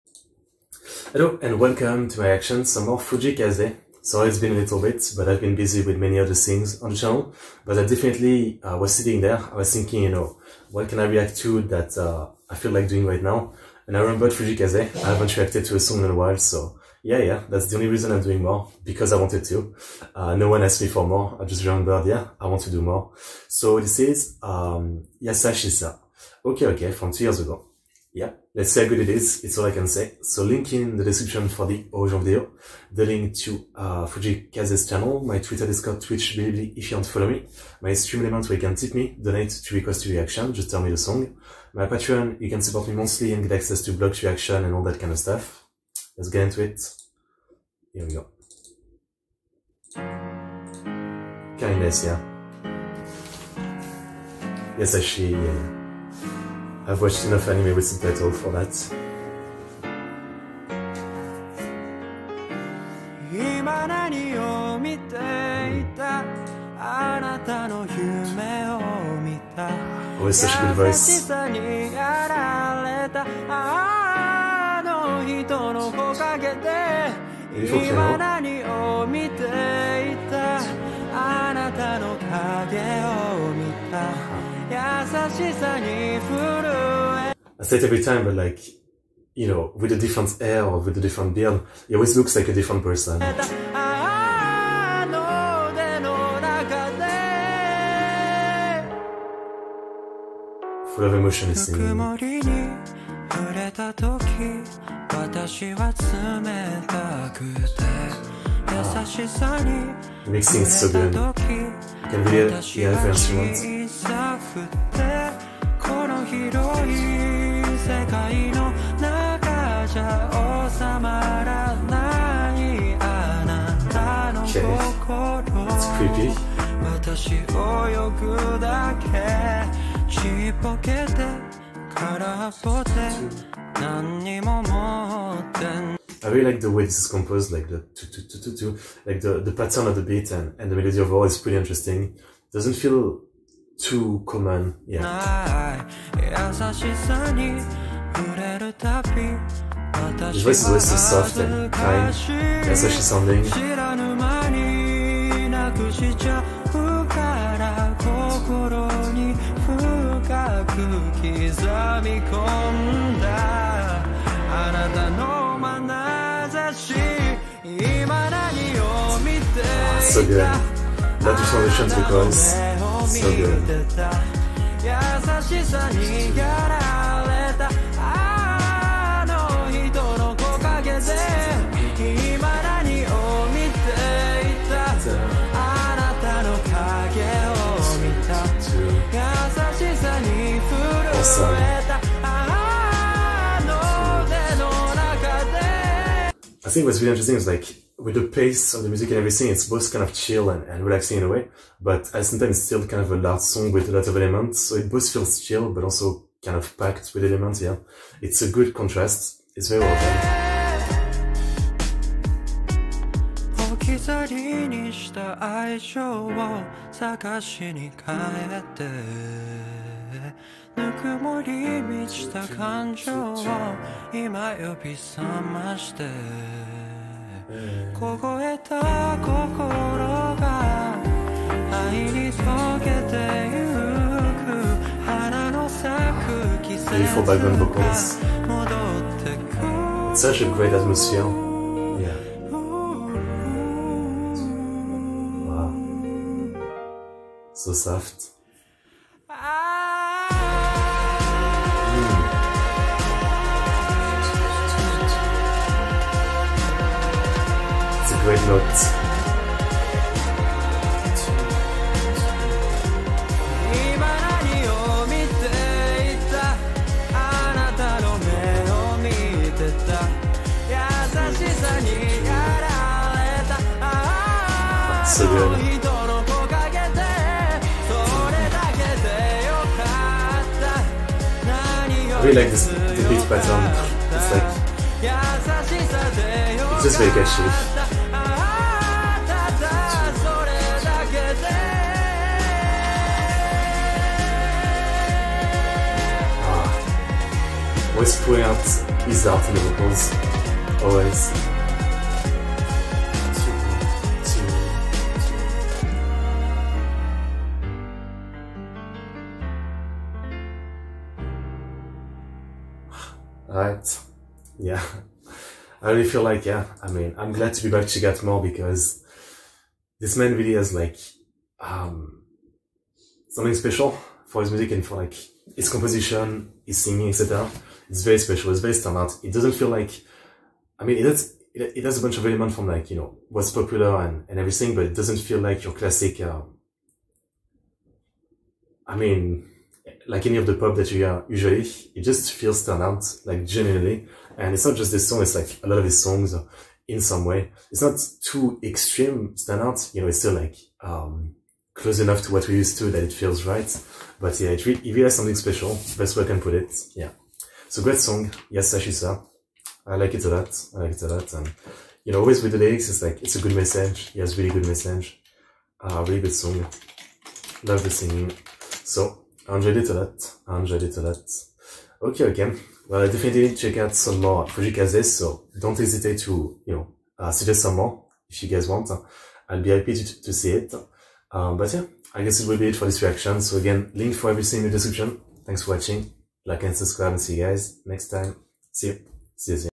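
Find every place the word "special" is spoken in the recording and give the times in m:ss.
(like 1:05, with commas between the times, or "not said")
5:23, 5:28, 5:55.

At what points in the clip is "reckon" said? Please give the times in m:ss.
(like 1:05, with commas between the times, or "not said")
not said.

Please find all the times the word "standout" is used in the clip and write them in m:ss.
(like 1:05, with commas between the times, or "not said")
5:28, 5:42, 5:49.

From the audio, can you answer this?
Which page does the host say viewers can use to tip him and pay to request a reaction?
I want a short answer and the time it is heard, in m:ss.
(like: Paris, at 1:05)
stream element, at 0:37.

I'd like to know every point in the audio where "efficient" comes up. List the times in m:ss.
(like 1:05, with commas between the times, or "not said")
not said.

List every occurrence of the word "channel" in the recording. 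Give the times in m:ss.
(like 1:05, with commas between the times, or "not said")
0:06, 0:34.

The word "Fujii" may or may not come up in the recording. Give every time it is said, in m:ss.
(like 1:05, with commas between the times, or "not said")
0:02, 0:14, 0:34, 6:14.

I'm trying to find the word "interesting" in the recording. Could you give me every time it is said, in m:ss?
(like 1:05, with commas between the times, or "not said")
2:21, 3:17.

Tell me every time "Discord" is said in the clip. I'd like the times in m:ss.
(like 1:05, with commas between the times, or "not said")
0:35.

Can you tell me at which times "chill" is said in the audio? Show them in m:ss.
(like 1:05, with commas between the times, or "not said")
3:20, 3:25.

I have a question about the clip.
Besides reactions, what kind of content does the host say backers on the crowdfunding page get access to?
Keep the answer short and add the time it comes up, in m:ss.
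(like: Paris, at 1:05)
blogs, at 0:43.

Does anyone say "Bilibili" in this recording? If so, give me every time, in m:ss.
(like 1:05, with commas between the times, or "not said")
0:36.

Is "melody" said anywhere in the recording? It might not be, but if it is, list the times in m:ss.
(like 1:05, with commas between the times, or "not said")
2:20.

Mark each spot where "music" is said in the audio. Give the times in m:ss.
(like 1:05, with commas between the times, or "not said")
3:18, 5:24.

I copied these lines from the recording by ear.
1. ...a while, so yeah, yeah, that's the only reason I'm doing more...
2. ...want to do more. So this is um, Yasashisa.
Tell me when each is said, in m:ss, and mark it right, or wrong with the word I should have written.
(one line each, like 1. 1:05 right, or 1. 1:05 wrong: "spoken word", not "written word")
1. 0:16 right
2. 0:22 right.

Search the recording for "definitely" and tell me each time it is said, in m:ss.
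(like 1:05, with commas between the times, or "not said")
0:07, 6:13.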